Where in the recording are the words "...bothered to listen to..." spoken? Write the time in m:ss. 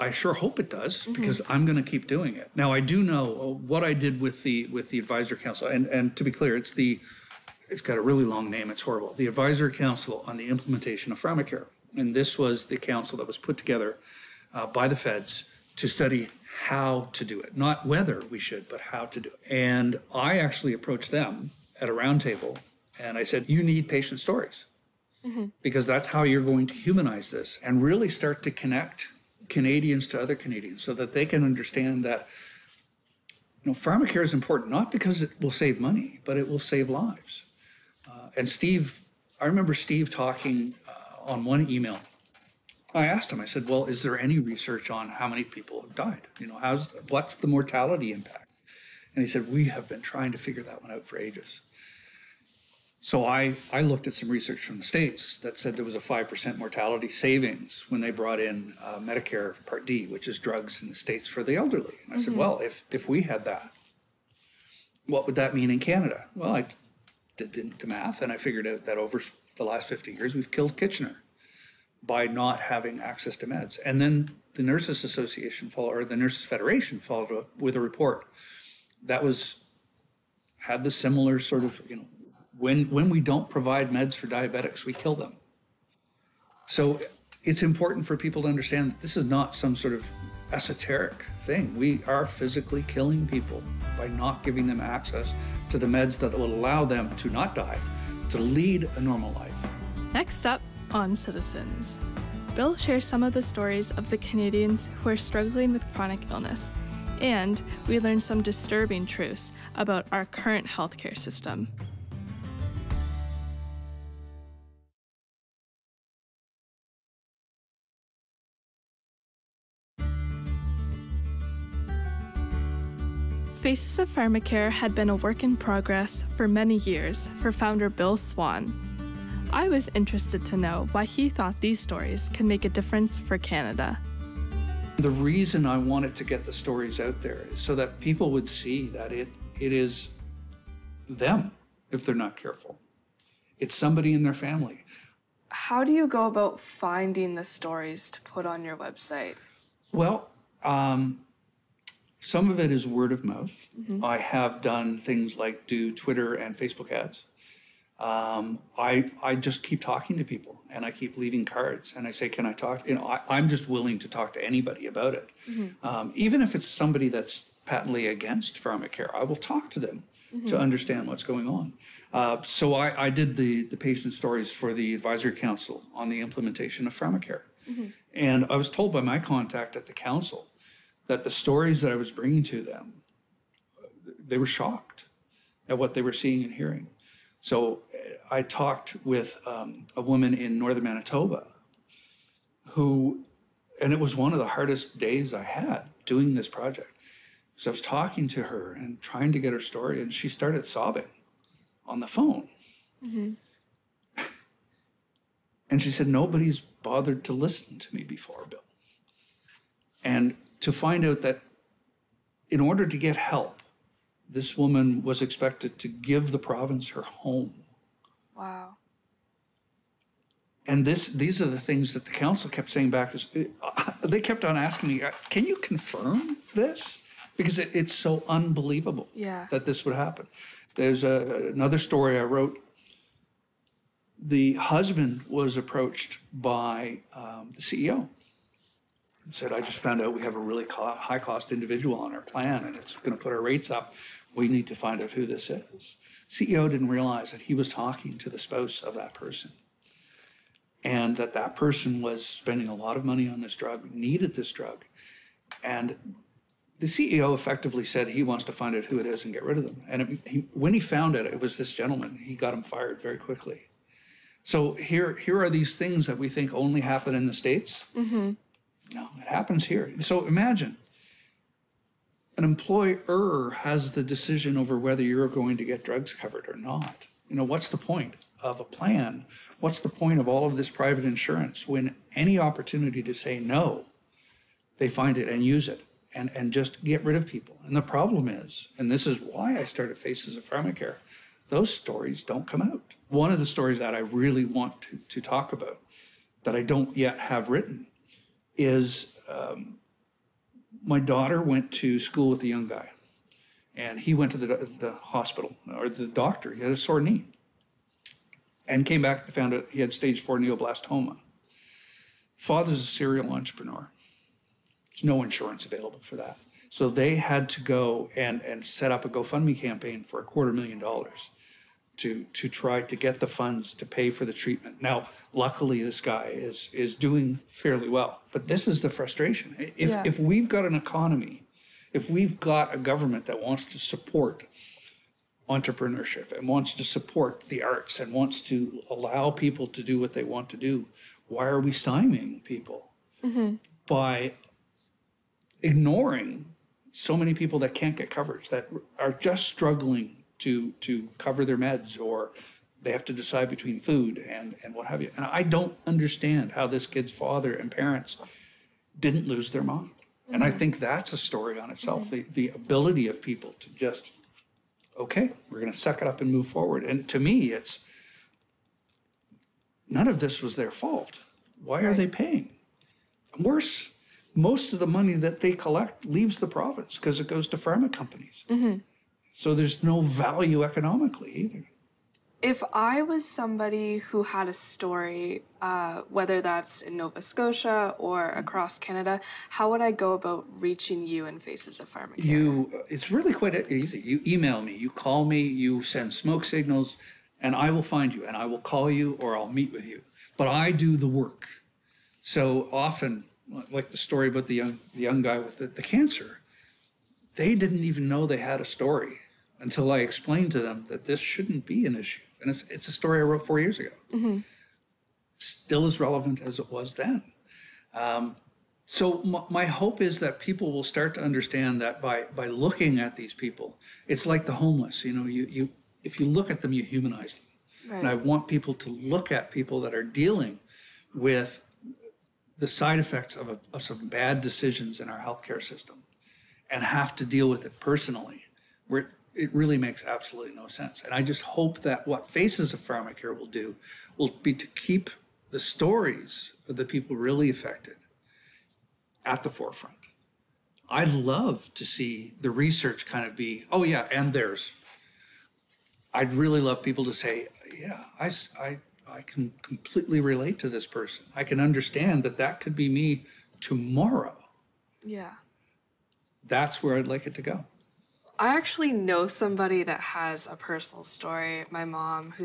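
3:26.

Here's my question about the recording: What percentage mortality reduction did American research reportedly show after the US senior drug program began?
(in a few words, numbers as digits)
5%.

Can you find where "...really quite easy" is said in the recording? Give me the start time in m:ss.
6:33.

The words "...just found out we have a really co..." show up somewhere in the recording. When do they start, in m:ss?
3:59.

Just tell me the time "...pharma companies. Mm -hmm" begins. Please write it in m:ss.
6:17.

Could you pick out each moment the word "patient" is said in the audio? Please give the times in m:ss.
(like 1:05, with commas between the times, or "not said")
0:23, 2:53.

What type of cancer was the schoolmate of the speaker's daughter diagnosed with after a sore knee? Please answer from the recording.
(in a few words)
neuroblastoma.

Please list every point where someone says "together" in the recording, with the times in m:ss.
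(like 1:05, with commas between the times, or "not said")
0:13.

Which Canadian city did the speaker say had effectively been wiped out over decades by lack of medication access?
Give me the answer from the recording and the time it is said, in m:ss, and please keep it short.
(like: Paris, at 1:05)
Kitchener, at 1:10.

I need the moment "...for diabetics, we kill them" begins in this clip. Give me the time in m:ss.
1:24.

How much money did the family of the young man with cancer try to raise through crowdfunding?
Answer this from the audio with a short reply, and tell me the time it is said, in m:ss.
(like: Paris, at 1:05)
a quarter million dollars, at 5:20.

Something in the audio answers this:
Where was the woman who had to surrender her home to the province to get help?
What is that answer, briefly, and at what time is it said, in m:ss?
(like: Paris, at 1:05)
northern Manitoba, at 3:10.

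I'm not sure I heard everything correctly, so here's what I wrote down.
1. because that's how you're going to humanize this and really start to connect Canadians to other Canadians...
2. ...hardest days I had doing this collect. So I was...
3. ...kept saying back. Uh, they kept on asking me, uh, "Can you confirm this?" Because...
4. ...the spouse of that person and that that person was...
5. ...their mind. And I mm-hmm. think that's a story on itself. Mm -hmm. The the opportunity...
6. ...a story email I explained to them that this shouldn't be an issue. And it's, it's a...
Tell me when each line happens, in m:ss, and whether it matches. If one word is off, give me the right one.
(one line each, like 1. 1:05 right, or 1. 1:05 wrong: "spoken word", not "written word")
1. 0:25 right
2. 3:14 wrong: "project", not "collect"
3. 3:42 right
4. 4:08 right
5. 5:59 wrong: "ability", not "opportunity"
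6. 6:48 wrong: "until", not "email".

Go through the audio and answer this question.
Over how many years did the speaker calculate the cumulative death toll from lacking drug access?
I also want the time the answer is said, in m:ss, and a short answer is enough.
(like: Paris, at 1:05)
50 years, at 1:09.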